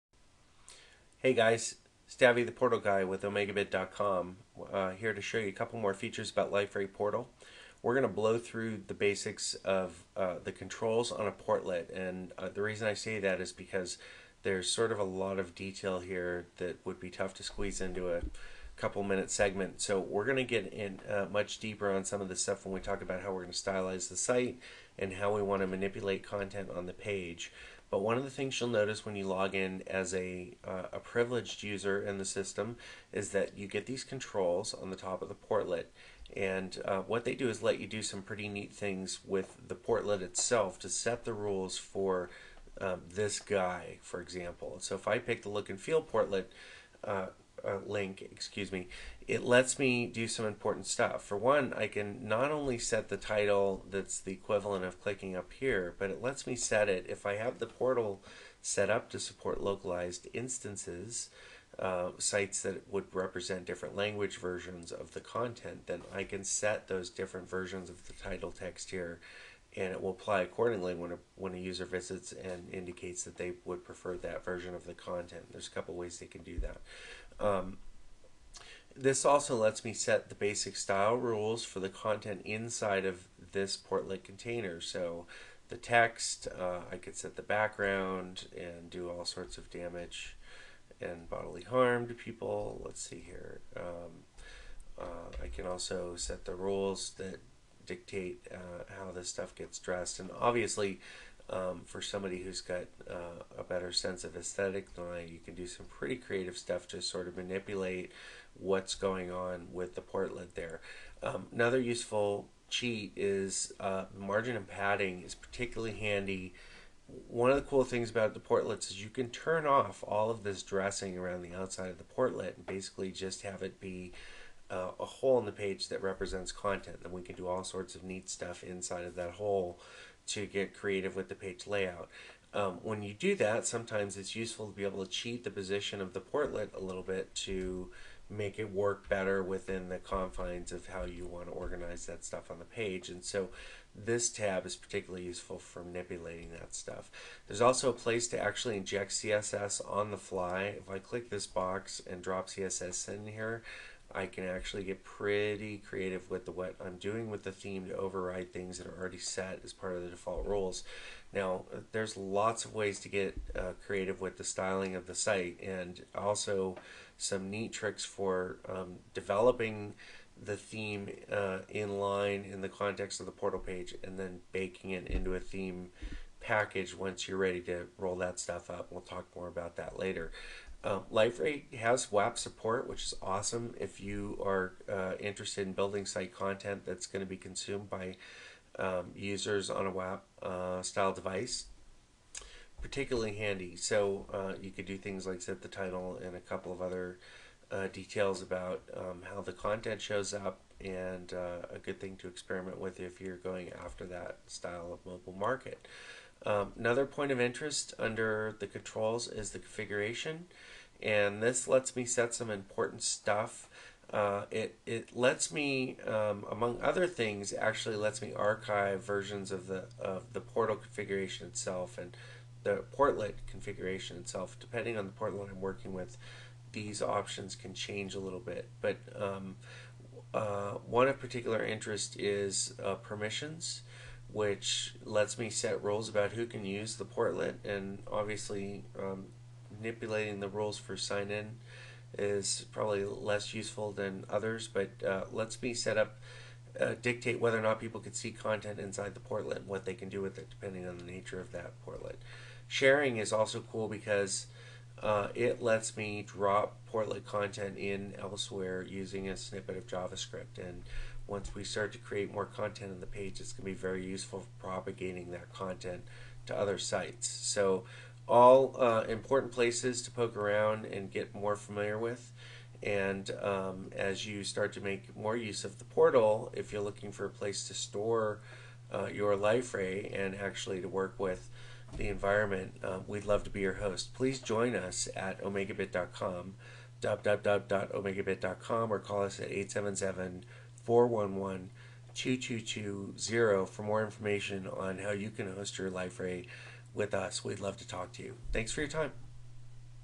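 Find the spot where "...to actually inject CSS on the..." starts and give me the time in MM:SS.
02:28.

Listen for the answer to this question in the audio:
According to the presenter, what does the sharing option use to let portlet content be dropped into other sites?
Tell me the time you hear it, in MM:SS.
04:19.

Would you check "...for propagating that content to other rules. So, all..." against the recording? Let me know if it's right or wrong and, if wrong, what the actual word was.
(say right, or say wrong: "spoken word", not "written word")
wrong: "sites", not "rules".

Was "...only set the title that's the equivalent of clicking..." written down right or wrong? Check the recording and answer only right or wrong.
right.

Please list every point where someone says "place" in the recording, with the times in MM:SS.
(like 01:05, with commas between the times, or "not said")
02:27, 04:29, 04:37.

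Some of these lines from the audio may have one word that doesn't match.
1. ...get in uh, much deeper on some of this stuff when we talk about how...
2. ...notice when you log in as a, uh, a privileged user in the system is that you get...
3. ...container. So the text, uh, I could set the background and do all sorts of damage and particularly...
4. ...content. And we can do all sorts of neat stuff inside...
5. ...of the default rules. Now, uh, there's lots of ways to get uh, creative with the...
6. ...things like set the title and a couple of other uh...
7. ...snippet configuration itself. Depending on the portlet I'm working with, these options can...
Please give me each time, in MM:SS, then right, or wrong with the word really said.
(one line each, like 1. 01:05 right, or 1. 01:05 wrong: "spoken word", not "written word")
1. 00:20 right
2. 00:28 right
3. 01:24 wrong: "bodily", not "particularly"
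4. 02:06 right
5. 02:39 right
6. 03:14 right
7. 03:42 wrong: "portlet", not "snippet".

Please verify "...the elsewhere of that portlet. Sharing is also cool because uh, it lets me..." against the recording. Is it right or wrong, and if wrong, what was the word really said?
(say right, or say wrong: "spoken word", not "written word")
wrong: "nature", not "elsewhere".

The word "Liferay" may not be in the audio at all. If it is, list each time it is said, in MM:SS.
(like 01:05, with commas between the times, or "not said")
00:06, 03:01, 04:55.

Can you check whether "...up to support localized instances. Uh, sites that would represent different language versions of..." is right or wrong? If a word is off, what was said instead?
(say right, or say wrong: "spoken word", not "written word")
right.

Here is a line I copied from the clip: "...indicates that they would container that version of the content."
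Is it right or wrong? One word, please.
wrong.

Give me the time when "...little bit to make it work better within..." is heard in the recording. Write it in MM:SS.
02:16.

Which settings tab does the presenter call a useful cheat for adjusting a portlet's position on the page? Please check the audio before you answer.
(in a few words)
Margin and padding.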